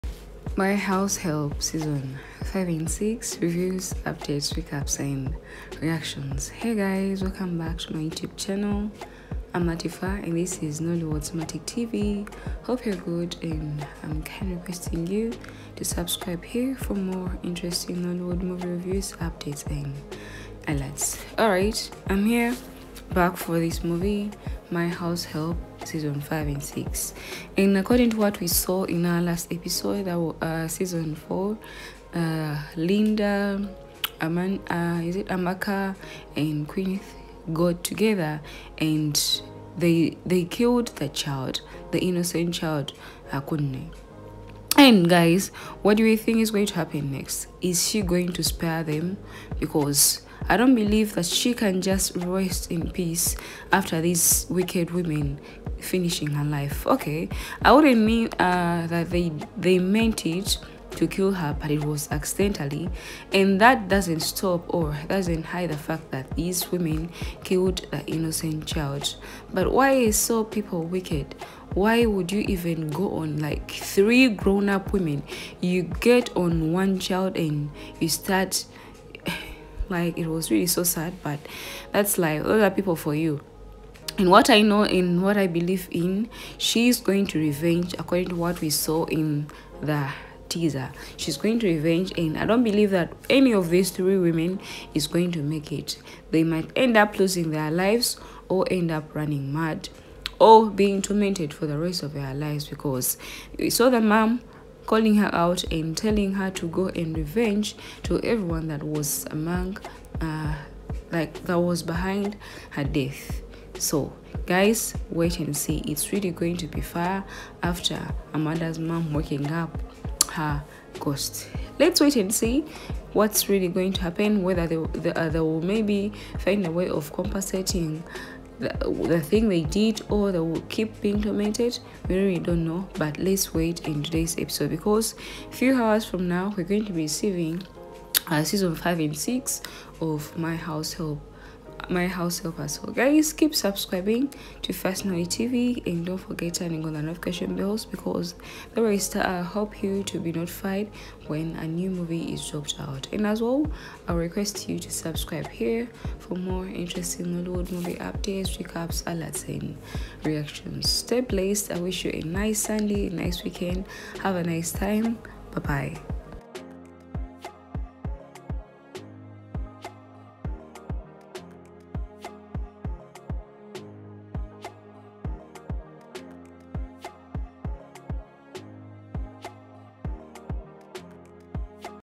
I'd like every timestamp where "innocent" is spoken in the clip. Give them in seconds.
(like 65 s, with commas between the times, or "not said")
41 s, 68 s.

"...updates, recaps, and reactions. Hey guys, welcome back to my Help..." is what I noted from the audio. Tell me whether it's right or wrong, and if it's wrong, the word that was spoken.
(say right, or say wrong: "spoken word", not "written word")
wrong: "YouTube", not "Help".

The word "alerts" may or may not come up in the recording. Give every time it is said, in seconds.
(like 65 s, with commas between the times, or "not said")
20 s, 159 s.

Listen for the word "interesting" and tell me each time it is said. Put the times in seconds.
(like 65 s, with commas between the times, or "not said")
17 s, 156 s.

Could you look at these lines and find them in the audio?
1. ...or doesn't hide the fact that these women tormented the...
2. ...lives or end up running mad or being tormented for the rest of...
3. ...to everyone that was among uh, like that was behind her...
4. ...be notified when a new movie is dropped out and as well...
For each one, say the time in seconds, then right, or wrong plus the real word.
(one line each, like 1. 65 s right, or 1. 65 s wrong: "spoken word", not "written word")
1. 64 s wrong: "killed", not "tormented"
2. 97 s right
3. 108 s right
4. 150 s right.